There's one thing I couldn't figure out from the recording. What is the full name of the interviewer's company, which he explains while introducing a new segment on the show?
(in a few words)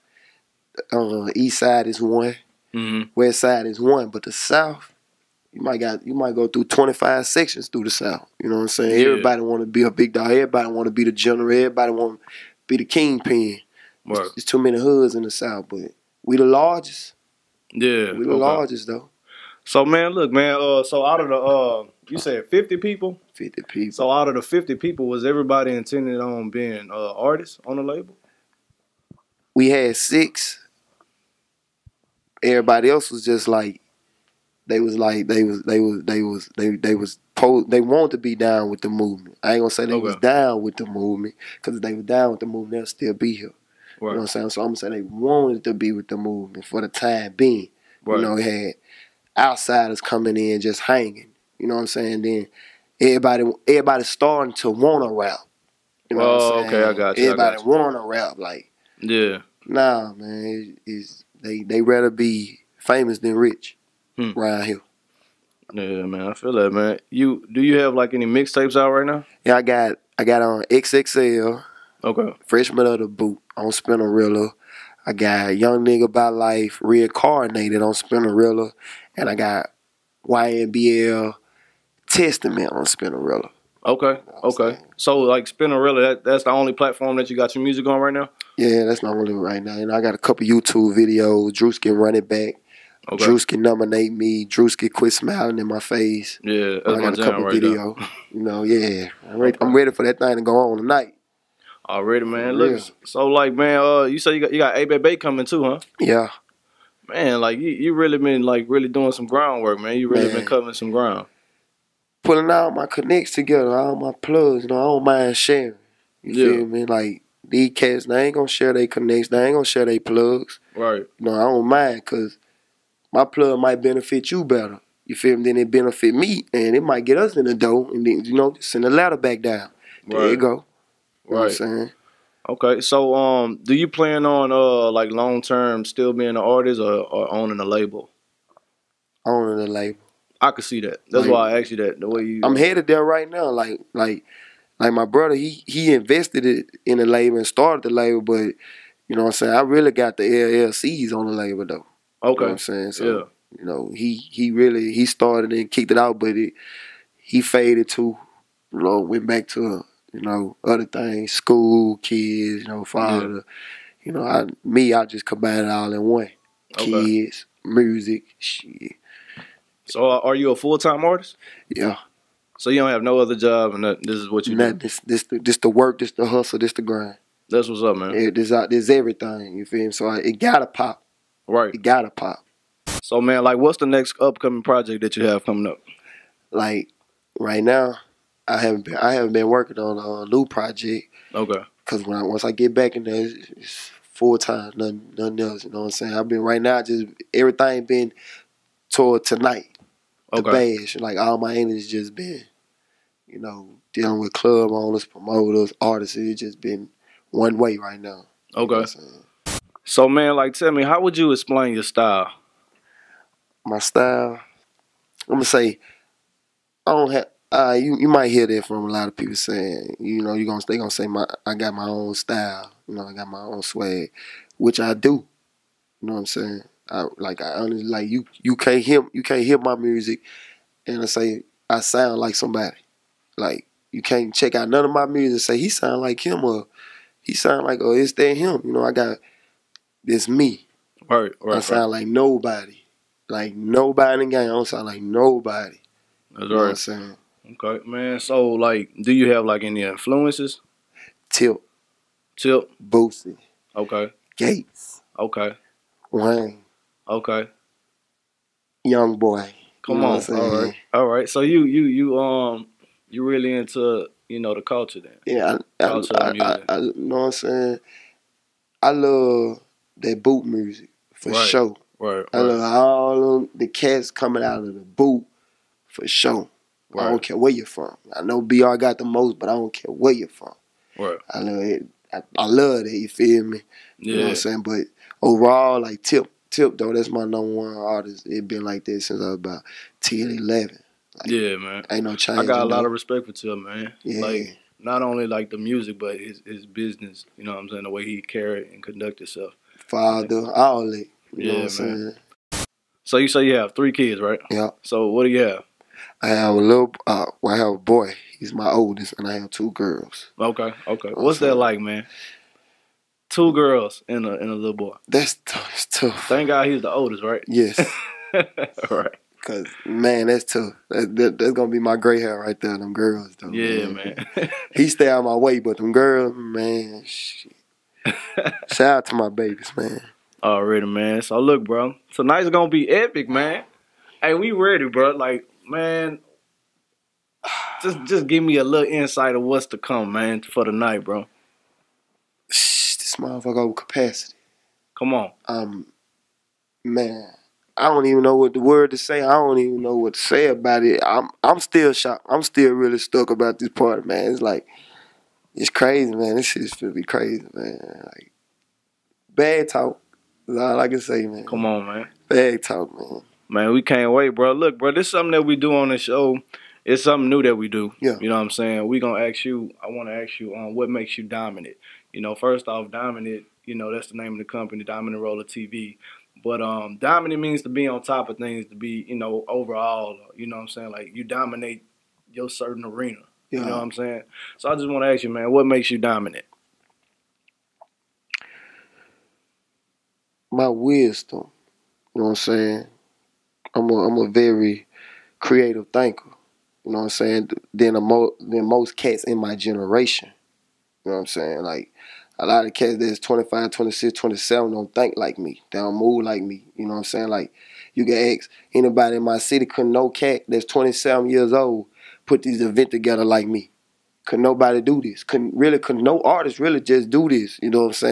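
Dominant Rolla TV.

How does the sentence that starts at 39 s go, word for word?
I ain't gonna say they okay.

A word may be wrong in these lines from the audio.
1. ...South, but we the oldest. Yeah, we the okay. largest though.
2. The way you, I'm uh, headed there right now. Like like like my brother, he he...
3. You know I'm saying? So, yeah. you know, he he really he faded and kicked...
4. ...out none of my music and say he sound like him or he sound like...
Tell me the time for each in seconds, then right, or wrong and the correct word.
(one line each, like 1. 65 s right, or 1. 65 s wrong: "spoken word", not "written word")
1. 15 s wrong: "largest", not "oldest"
2. 141 s right
3. 152 s wrong: "started", not "faded"
4. 234 s right.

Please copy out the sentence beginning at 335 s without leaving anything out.
Like, man, just just give me a little insight of what's to come, man, for the night, bro.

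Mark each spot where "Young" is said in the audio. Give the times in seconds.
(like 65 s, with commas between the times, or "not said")
75 s, 258 s.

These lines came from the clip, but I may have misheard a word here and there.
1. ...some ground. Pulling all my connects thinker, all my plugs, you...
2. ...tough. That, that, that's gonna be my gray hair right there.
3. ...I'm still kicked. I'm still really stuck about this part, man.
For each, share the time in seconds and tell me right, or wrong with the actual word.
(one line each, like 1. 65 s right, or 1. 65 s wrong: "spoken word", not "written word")
1. 110 s wrong: "together", not "thinker"
2. 320 s right
3. 351 s wrong: "shocked", not "kicked".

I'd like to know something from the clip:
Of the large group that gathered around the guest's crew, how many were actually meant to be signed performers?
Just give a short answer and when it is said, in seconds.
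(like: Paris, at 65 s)
6, at 29 s.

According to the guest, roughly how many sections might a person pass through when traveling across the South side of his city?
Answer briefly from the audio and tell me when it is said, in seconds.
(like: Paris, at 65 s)
25, at 6 s.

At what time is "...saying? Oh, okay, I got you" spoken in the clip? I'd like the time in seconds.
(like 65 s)
56 s.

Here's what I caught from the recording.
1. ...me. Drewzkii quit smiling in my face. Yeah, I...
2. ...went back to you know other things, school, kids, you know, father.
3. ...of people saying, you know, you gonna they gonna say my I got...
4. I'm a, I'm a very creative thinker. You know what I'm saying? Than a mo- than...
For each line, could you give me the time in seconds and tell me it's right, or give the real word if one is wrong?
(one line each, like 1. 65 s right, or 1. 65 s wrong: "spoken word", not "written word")
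1. 94 s right
2. 158 s right
3. 219 s right
4. 393 s right.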